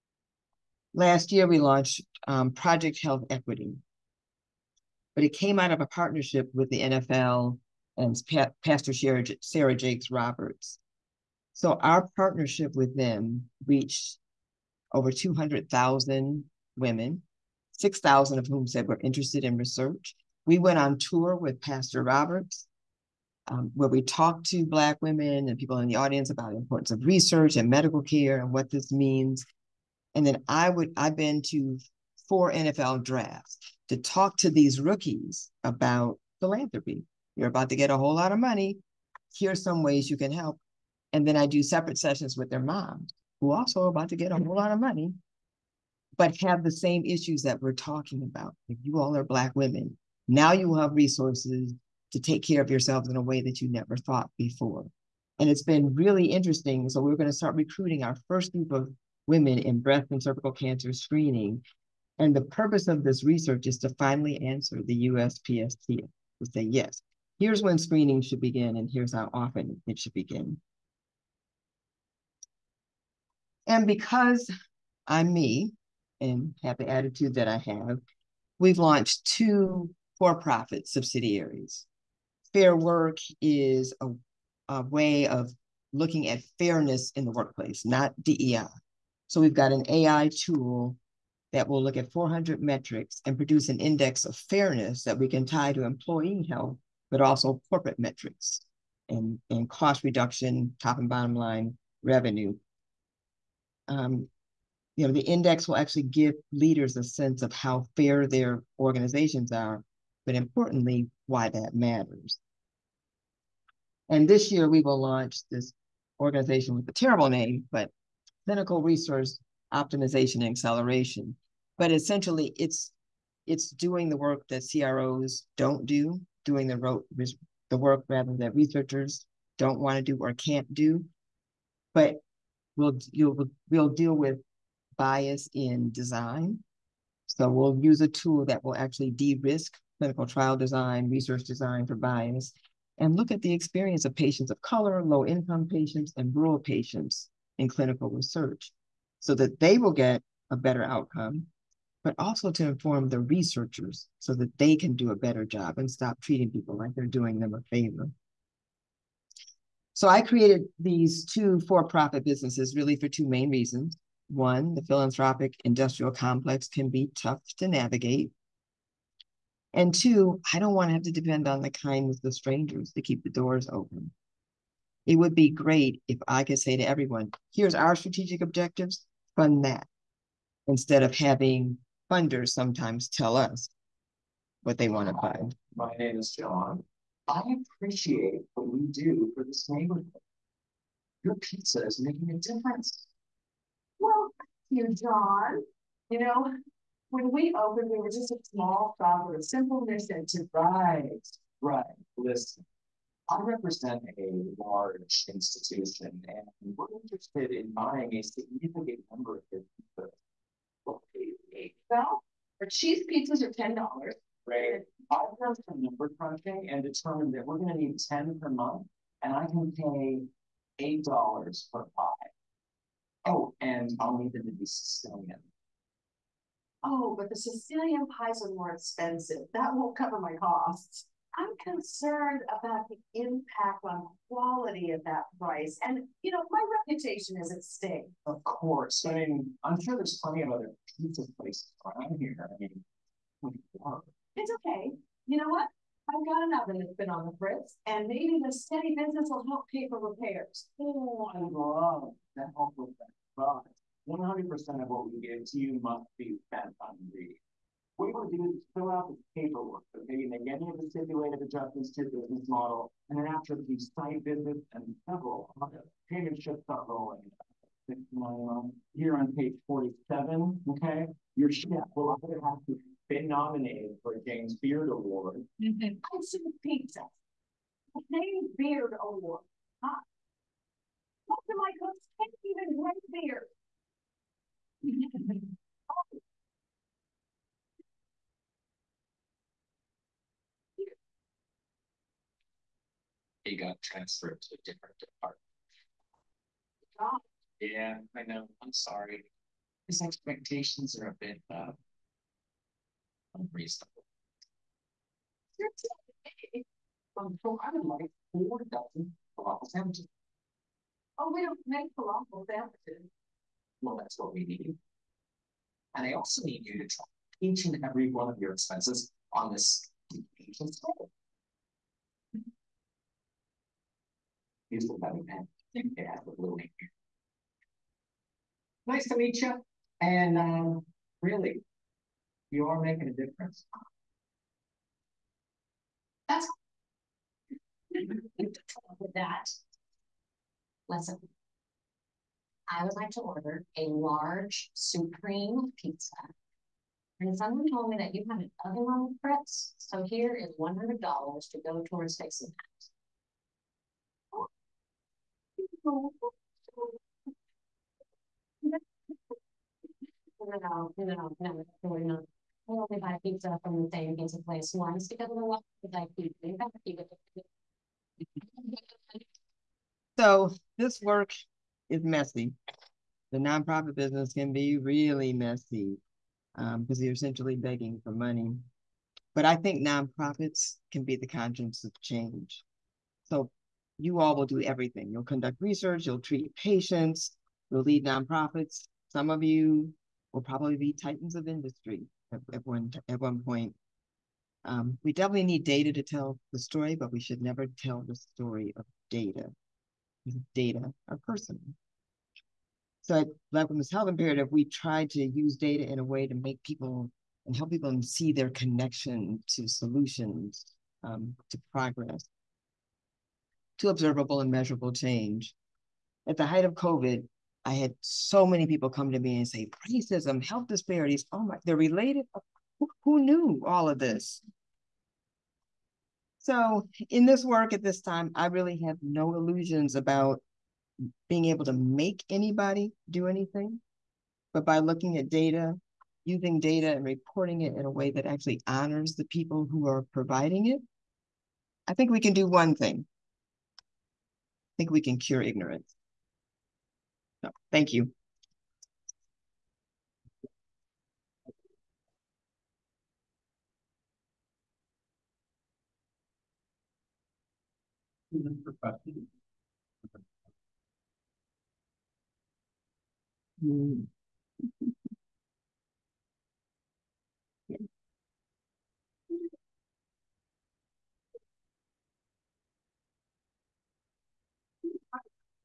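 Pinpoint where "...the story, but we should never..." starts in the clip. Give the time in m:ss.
6:36.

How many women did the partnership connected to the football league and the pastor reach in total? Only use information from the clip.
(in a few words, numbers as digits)
200,000.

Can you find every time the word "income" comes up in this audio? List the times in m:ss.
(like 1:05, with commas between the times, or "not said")
2:25.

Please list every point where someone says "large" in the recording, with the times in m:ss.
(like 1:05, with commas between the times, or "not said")
3:24, 5:43.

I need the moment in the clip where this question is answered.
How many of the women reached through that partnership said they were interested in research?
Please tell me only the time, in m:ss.
0:17.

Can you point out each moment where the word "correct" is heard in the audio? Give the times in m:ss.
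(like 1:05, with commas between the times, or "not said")
not said.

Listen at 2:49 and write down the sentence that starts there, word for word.
And two, I don't want to have to depend on the kindness of strangers to keep the doors open.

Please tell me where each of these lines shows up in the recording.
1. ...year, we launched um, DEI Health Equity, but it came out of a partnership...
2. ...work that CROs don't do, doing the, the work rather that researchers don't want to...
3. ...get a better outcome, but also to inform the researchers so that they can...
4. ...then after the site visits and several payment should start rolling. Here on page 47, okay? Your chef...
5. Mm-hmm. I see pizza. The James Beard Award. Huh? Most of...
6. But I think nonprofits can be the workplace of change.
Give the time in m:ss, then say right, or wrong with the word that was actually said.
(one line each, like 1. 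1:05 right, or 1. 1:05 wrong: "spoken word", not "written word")
1. 0:01 wrong: "Project", not "DEI"
2. 2:04 right
3. 2:29 right
4. 4:23 right
5. 4:35 right
6. 6:19 wrong: "conscience", not "workplace".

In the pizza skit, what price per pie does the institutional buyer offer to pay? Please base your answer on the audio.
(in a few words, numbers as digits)
$8.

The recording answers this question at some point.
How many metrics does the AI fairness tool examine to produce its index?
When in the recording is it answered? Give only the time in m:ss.
1:32.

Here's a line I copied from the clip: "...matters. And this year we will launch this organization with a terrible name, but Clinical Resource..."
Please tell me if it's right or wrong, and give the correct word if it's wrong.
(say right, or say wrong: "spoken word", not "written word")
right.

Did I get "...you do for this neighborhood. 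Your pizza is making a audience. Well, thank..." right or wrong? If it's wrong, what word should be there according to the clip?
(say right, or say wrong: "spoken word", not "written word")
wrong: "difference", not "audience".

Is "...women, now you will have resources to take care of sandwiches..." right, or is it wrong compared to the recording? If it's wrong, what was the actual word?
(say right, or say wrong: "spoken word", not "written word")
wrong: "yourselves", not "sandwiches".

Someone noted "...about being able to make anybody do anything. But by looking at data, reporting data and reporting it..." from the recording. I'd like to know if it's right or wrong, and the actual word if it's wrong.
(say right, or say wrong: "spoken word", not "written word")
wrong: "using", not "reporting".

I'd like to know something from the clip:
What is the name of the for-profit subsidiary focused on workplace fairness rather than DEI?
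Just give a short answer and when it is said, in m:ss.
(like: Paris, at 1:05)
Fair work, at 1:22.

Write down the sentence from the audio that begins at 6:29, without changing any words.
Some of you will probably be titans of industry at, at one at one point.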